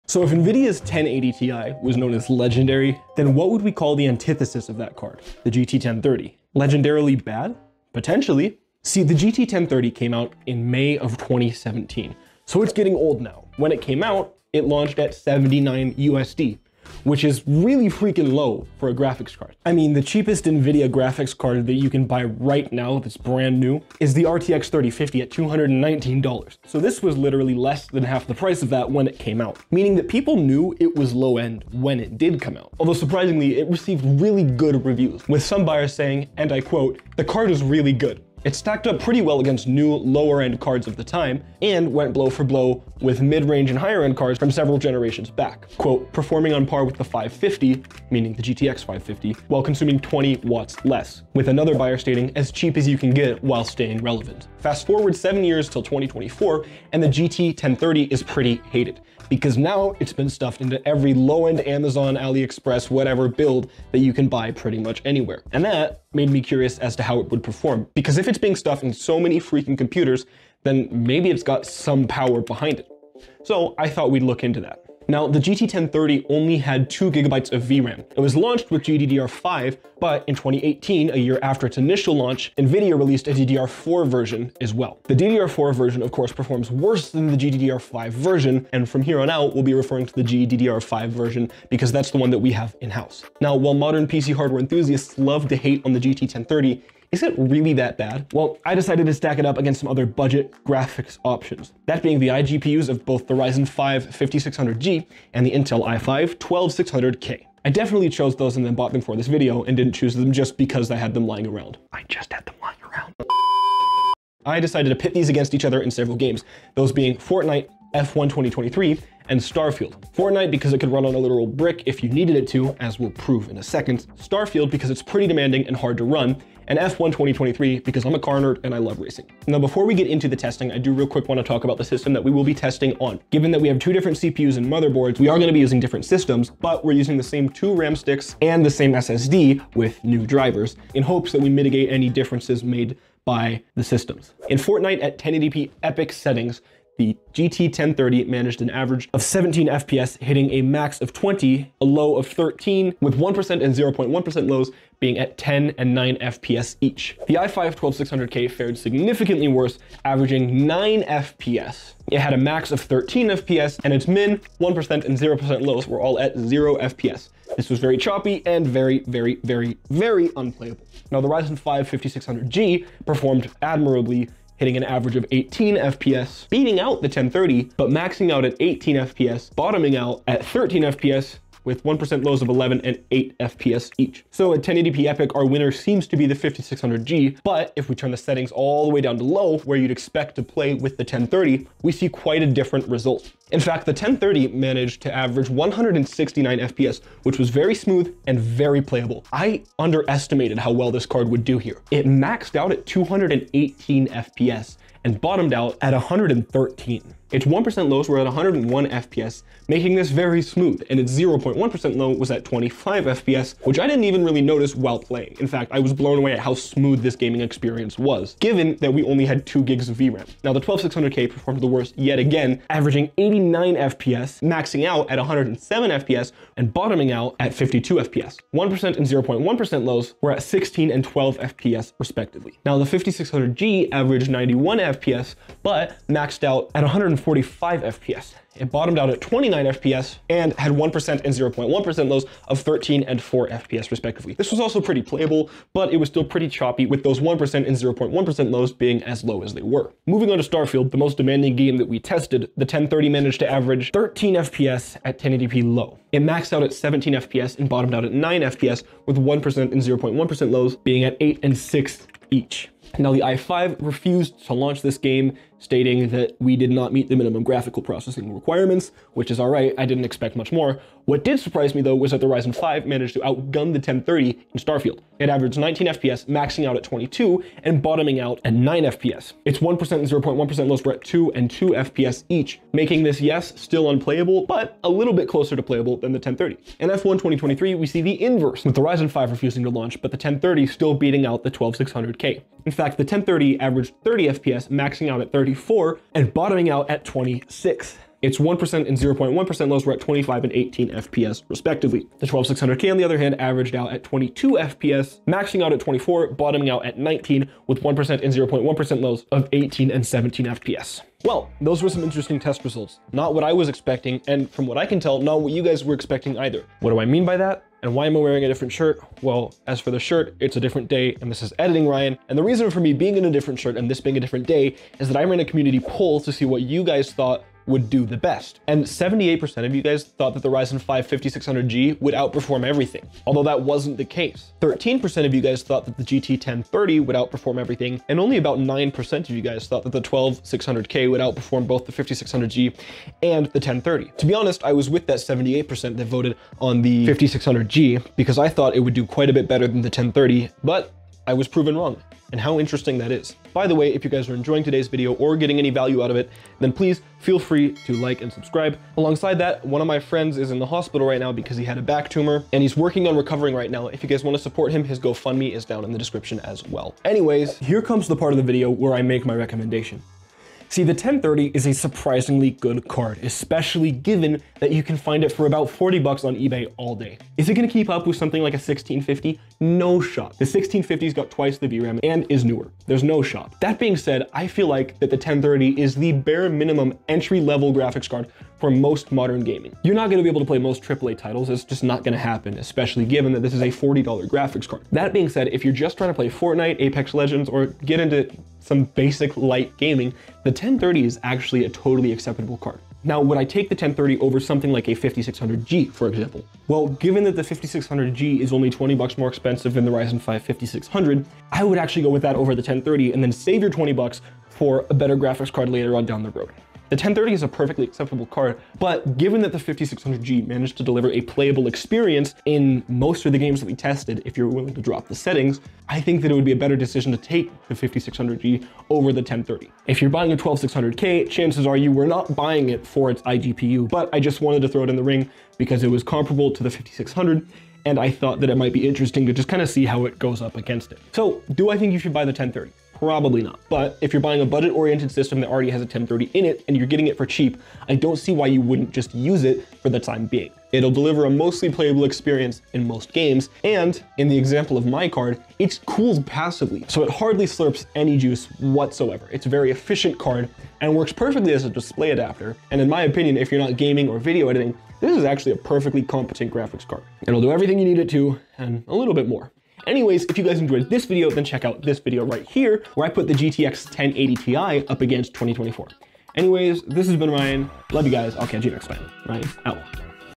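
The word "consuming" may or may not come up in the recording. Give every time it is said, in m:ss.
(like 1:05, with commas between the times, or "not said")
0:49.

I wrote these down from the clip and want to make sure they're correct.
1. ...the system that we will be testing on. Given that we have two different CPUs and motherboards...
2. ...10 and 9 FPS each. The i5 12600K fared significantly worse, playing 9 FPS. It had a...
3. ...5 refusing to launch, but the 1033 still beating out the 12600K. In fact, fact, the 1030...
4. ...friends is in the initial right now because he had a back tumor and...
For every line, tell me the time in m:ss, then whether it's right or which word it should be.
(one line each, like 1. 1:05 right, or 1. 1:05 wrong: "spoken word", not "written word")
1. 2:11 right
2. 2:35 wrong: "averaging", not "playing"
3. 4:49 wrong: "1030", not "1033"
4. 5:59 wrong: "hospital", not "initial".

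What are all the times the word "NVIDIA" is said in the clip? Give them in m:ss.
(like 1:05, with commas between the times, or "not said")
0:00, 0:20, 1:22.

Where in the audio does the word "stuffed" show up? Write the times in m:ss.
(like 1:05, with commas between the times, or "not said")
1:00, 1:08.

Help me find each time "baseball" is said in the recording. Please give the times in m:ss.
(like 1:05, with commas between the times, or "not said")
not said.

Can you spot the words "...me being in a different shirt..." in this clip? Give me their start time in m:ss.
5:22.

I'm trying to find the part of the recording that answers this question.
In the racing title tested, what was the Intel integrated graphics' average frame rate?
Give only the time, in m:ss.
5:04.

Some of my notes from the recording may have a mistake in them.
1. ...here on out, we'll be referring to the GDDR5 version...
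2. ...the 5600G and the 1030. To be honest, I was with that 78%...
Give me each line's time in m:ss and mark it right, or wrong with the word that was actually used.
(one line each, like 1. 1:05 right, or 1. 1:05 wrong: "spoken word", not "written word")
1. 1:29 right
2. 5:41 right.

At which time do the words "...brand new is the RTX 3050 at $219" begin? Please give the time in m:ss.
0:23.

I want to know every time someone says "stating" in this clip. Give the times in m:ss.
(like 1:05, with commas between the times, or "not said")
0:51, 4:25.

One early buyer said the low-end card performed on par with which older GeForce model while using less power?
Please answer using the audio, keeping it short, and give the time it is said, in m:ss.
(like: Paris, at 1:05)
GTX 550, at 0:48.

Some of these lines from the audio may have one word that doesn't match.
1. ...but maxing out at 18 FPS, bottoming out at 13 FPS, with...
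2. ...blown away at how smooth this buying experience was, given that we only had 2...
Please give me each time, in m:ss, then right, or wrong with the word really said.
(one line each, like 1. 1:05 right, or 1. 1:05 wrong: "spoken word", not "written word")
1. 2:57 right
2. 3:35 wrong: "gaming", not "buying".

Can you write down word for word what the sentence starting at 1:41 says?
That being the iGPUs of both the Ryzen 5 5600G and the Intel i5 12600K.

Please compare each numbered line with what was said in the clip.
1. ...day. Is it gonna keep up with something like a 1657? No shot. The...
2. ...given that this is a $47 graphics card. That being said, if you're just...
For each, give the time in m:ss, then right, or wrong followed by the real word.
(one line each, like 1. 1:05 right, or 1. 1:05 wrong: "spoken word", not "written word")
1. 6:16 wrong: "1650", not "1657"
2. 6:33 wrong: "40", not "47".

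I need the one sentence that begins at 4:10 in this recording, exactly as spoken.
Moving on to Starfield, the most demanding game that we tested, the 1030 managed to average 13 FPS at 1080p low.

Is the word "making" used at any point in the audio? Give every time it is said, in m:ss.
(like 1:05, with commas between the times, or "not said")
3:29, 4:42.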